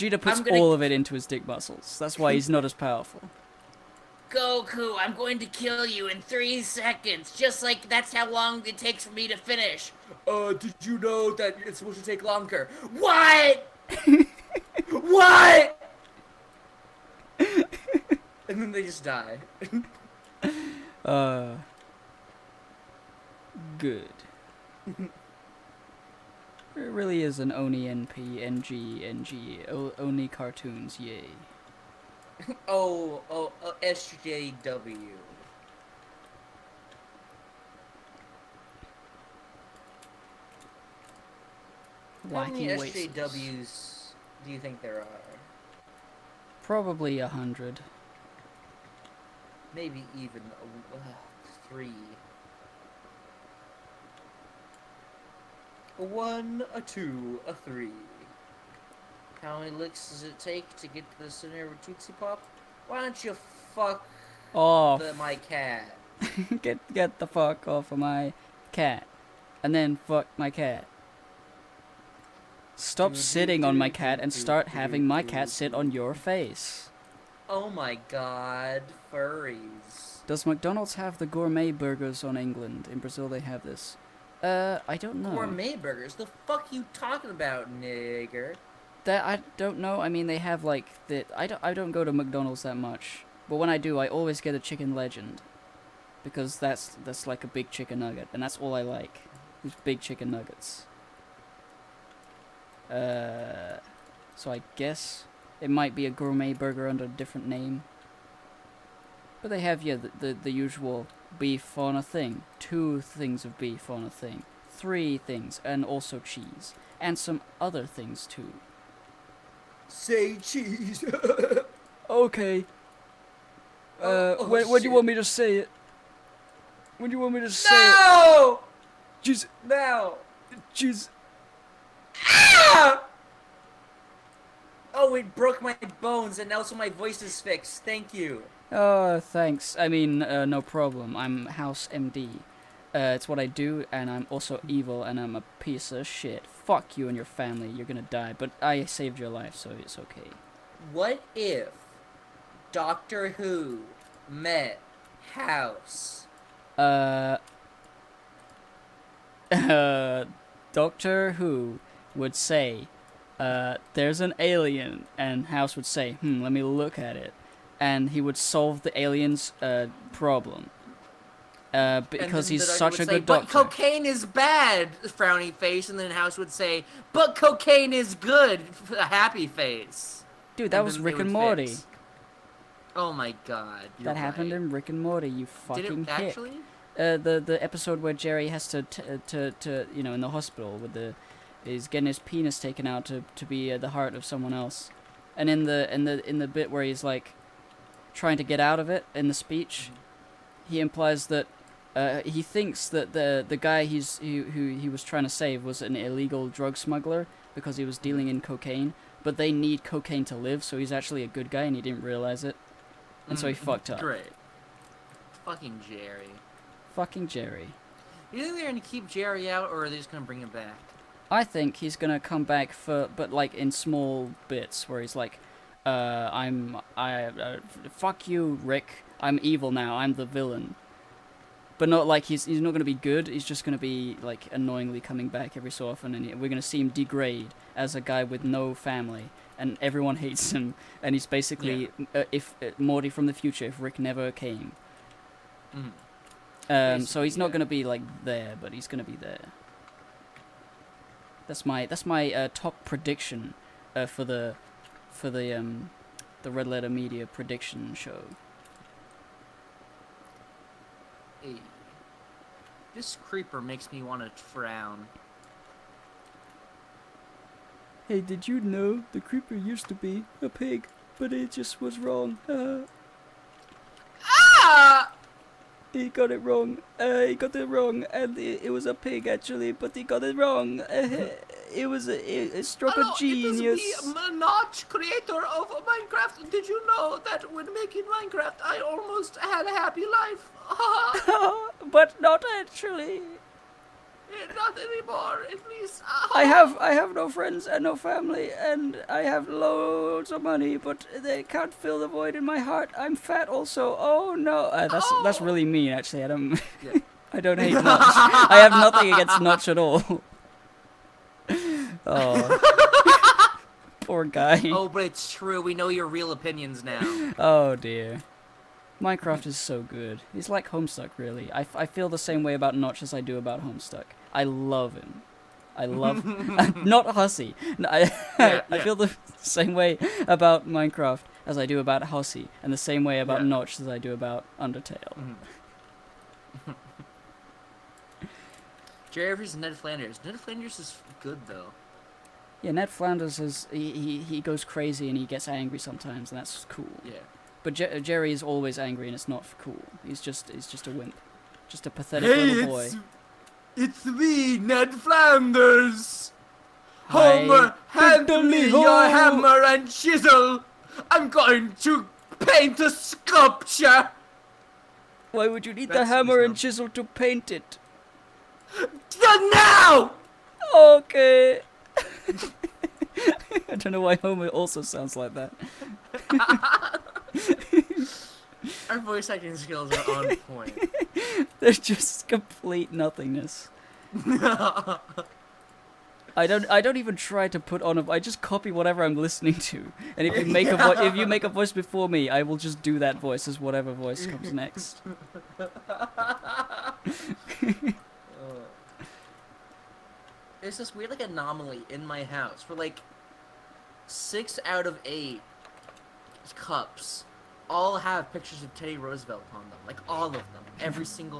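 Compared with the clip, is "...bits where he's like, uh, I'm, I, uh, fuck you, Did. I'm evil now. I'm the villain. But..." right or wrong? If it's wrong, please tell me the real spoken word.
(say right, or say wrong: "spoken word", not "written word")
wrong: "Rick", not "Did".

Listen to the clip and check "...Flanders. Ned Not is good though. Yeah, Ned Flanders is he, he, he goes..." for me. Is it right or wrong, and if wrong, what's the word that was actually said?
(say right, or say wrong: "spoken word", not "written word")
wrong: "Flanders", not "Not".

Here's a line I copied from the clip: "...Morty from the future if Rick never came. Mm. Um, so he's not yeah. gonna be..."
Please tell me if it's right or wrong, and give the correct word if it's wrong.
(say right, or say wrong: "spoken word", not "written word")
right.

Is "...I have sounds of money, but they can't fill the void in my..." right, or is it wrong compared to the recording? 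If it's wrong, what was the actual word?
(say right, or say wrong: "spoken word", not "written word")
wrong: "loads", not "sounds".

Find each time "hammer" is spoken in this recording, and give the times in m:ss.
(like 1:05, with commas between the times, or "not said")
5:59, 6:06.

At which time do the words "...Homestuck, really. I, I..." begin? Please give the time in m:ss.
5:20.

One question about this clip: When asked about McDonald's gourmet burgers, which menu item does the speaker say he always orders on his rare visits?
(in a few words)
Chicken Legend.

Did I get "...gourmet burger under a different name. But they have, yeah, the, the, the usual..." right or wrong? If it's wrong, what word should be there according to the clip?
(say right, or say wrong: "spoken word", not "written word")
right.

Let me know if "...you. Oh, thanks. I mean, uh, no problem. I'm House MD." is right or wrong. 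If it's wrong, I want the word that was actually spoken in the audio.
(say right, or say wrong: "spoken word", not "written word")
right.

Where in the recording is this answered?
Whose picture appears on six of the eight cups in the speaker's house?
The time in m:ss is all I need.
6:48.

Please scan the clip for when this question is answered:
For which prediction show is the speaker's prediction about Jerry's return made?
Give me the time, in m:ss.
4:16.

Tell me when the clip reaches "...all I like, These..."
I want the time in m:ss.
1:38.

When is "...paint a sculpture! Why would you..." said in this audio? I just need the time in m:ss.
6:02.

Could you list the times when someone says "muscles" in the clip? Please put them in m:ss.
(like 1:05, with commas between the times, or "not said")
0:01.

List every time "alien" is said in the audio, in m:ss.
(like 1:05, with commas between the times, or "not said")
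2:44, 2:48.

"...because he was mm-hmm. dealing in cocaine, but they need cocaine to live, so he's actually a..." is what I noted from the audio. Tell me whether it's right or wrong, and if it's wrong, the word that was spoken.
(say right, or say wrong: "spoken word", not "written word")
right.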